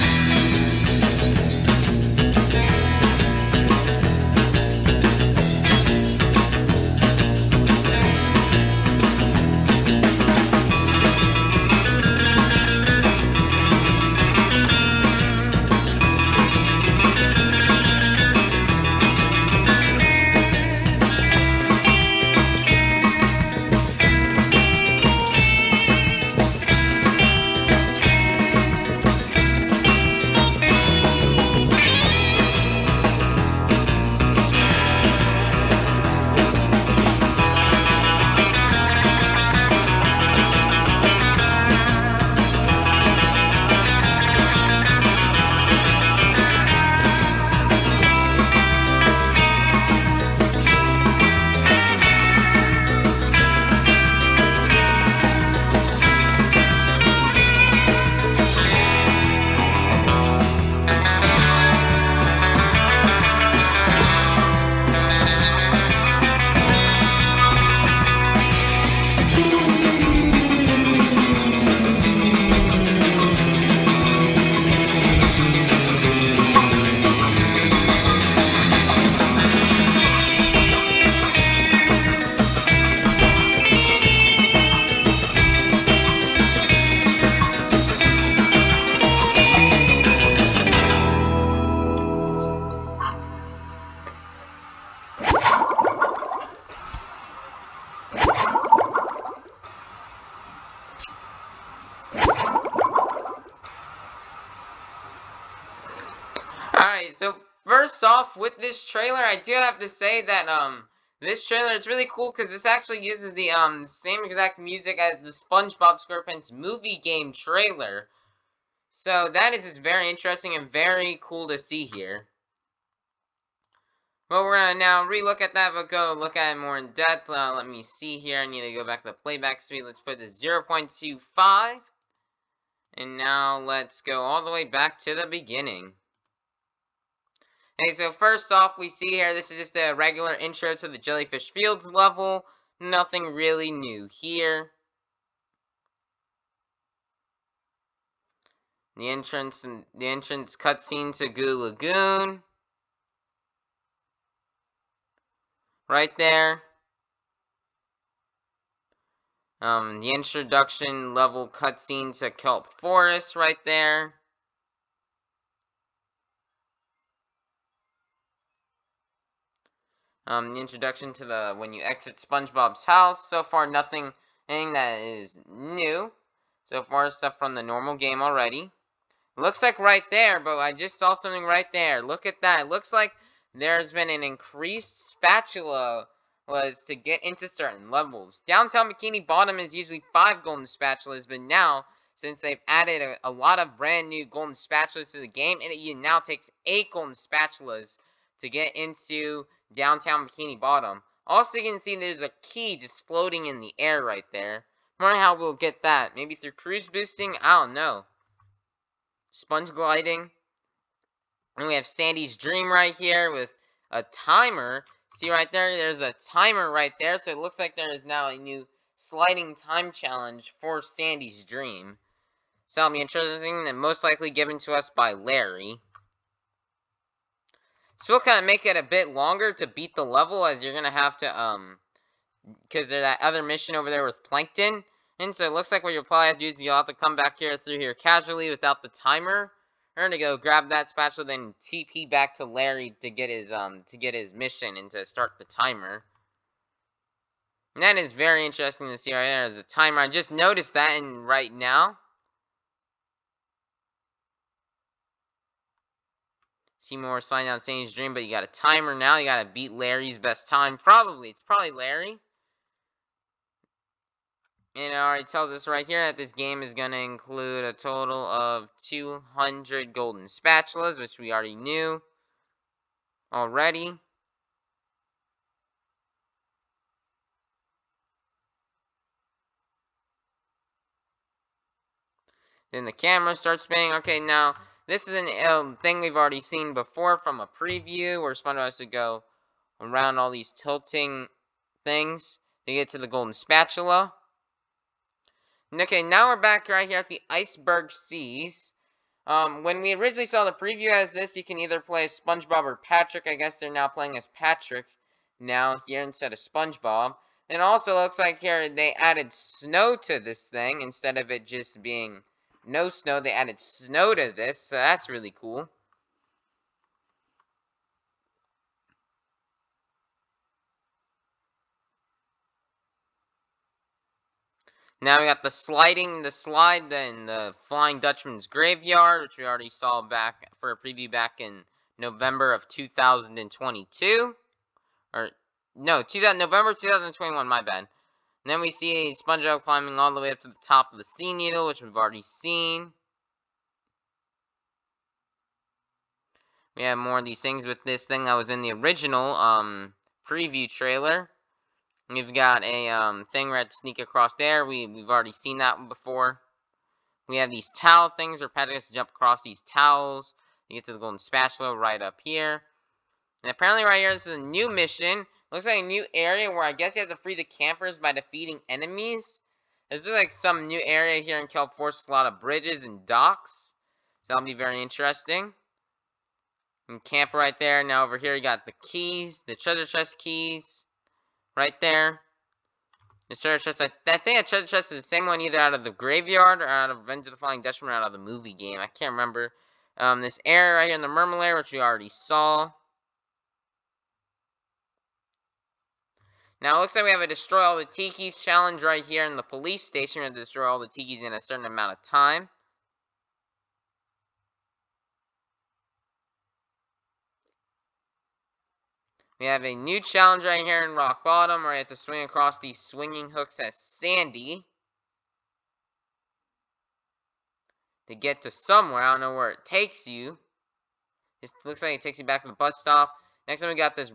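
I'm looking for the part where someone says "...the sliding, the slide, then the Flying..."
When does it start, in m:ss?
5:25.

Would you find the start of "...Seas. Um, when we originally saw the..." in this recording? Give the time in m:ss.
4:57.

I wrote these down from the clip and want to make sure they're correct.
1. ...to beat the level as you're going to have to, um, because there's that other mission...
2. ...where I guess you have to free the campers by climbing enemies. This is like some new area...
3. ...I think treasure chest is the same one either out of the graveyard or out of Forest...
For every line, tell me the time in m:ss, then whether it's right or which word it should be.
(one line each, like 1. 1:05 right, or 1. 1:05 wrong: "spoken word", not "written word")
1. 3:49 right
2. 6:06 wrong: "defeating", not "climbing"
3. 6:24 wrong: "Revenge", not "Forest".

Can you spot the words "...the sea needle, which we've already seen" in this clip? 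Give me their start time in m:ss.
5:40.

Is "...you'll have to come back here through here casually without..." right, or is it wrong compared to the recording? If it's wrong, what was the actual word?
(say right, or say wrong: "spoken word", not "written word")
right.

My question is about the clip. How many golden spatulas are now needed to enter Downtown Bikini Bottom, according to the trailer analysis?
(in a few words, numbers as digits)
8.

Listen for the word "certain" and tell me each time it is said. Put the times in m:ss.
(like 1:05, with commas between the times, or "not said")
3:07, 6:41.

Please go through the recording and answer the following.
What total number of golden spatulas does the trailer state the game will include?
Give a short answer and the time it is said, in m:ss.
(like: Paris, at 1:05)
200, at 4:28.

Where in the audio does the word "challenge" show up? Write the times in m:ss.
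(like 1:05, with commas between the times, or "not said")
3:39, 6:38, 6:49.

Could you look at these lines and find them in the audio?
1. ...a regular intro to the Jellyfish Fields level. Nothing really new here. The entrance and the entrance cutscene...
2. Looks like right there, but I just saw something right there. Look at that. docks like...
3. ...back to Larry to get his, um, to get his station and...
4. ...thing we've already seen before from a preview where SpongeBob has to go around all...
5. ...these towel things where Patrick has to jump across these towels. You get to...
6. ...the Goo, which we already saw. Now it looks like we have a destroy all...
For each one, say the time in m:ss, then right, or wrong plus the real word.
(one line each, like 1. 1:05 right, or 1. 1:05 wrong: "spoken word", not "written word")
1. 2:19 right
2. 2:59 wrong: "looks", not "docks"
3. 4:02 wrong: "mission", not "station"
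4. 4:45 right
5. 5:57 right
6. 6:31 wrong: "Mermalair", not "Goo".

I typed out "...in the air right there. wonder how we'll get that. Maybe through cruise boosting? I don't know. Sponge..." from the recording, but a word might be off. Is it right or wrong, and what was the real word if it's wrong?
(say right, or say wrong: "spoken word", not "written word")
right.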